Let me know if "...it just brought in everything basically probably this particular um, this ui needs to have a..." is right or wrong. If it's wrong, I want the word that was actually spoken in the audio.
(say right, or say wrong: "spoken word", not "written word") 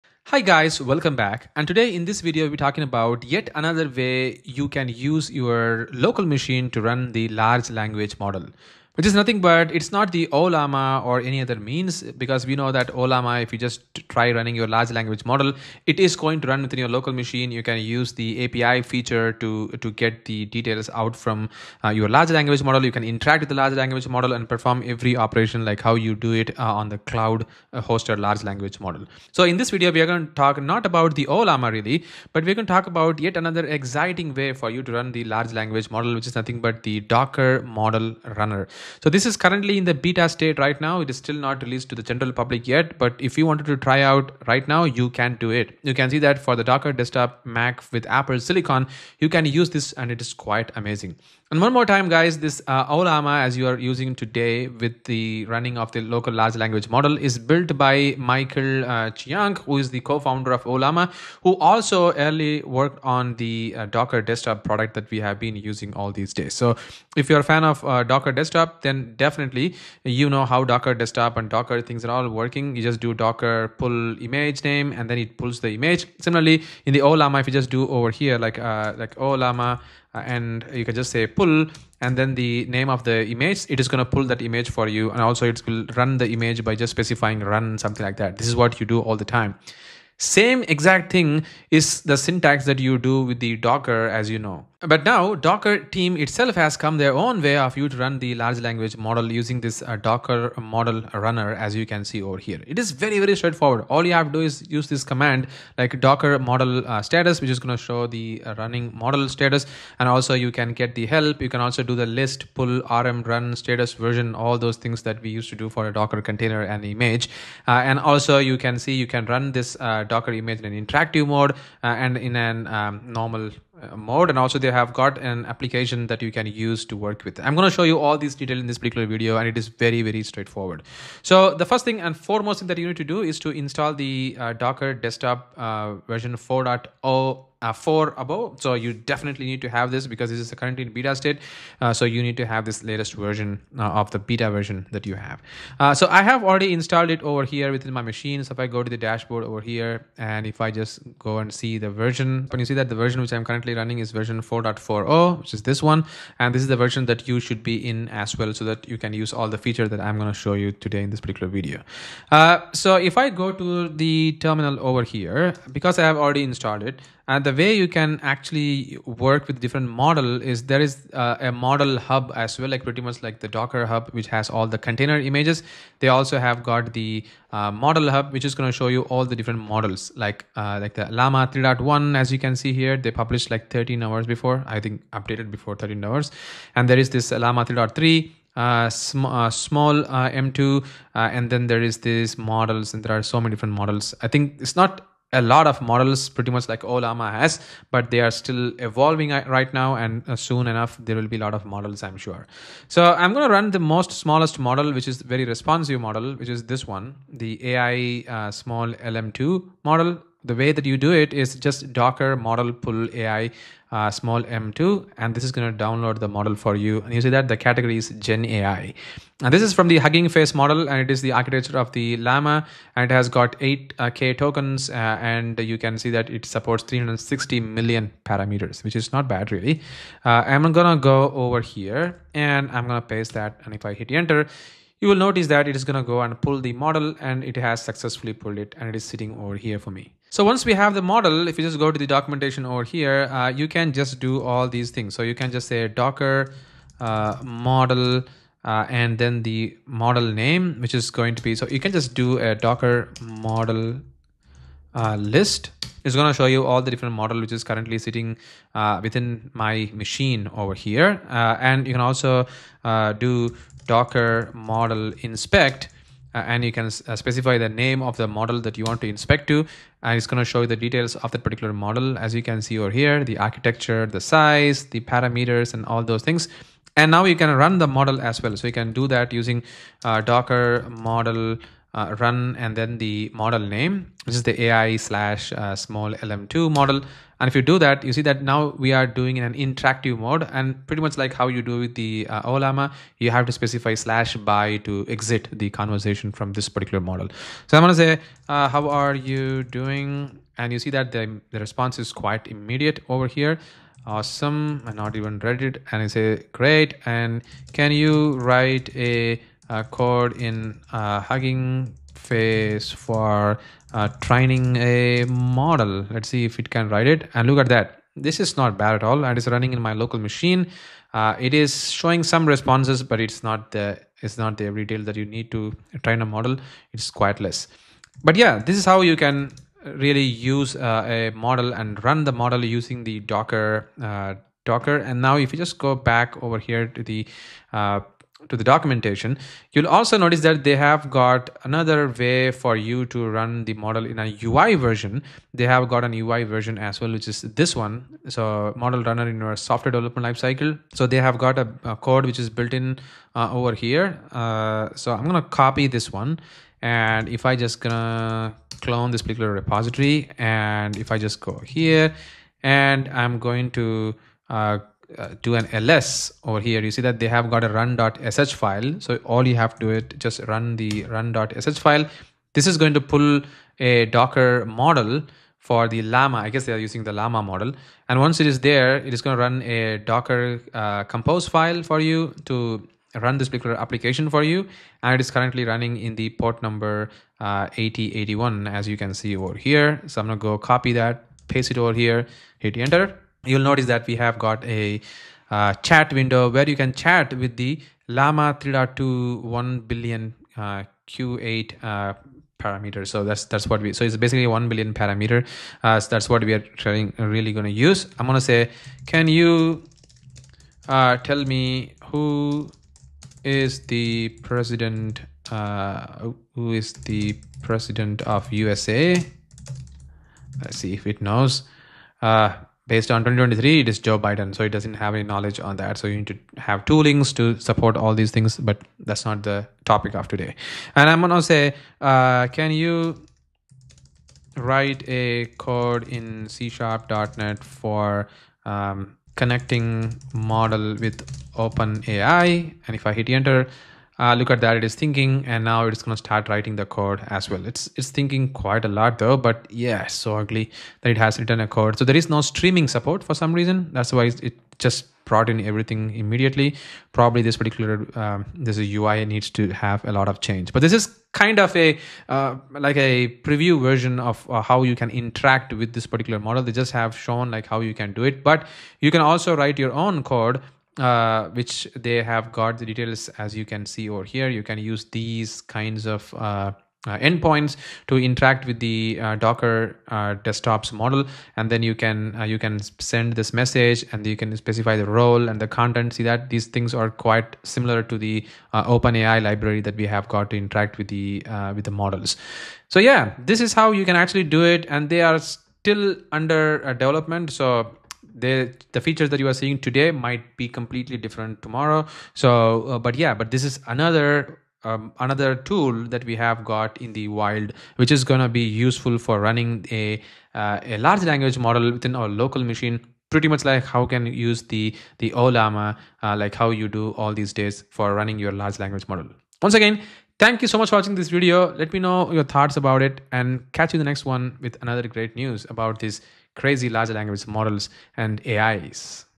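wrong: "immediately", not "basically".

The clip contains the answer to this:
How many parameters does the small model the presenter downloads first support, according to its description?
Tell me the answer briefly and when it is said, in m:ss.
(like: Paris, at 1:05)
360 million, at 3:46.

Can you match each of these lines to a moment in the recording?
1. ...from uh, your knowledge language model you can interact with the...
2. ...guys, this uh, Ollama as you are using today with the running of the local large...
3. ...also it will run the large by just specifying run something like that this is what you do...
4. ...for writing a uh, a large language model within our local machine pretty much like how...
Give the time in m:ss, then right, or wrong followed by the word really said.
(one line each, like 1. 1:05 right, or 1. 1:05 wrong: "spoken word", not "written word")
1. 0:21 wrong: "large", not "knowledge"
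2. 0:52 right
3. 1:25 wrong: "image", not "large"
4. 8:29 wrong: "running", not "writing".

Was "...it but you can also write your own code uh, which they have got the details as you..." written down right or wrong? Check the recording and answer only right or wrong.
right.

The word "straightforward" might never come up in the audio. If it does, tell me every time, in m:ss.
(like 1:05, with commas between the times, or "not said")
1:43, 2:10.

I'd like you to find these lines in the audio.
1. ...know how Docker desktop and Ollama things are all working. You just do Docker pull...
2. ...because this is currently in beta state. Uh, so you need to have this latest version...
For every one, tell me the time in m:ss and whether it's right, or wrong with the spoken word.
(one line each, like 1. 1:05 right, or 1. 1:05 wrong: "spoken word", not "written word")
1. 1:10 wrong: "Docker", not "Ollama"
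2. 2:20 right.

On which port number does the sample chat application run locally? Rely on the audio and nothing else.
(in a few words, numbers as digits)
8081.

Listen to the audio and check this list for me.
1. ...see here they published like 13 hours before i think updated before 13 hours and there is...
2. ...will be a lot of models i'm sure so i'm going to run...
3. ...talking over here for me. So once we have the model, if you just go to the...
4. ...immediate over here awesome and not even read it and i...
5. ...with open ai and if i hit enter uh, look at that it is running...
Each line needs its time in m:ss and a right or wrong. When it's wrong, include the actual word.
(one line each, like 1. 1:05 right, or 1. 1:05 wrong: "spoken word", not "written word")
1. 3:02 right
2. 3:21 right
3. 3:59 wrong: "sitting", not "talking"
4. 5:02 right
5. 7:21 wrong: "thinking", not "running".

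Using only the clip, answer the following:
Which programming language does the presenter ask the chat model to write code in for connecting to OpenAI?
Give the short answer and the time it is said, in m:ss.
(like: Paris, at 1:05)
C# .NET, at 7:16.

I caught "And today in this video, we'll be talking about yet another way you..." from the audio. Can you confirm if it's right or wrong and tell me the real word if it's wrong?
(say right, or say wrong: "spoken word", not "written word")
right.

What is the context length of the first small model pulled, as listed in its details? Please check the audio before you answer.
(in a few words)
8k tokens.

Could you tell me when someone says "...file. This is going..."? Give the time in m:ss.
6:11.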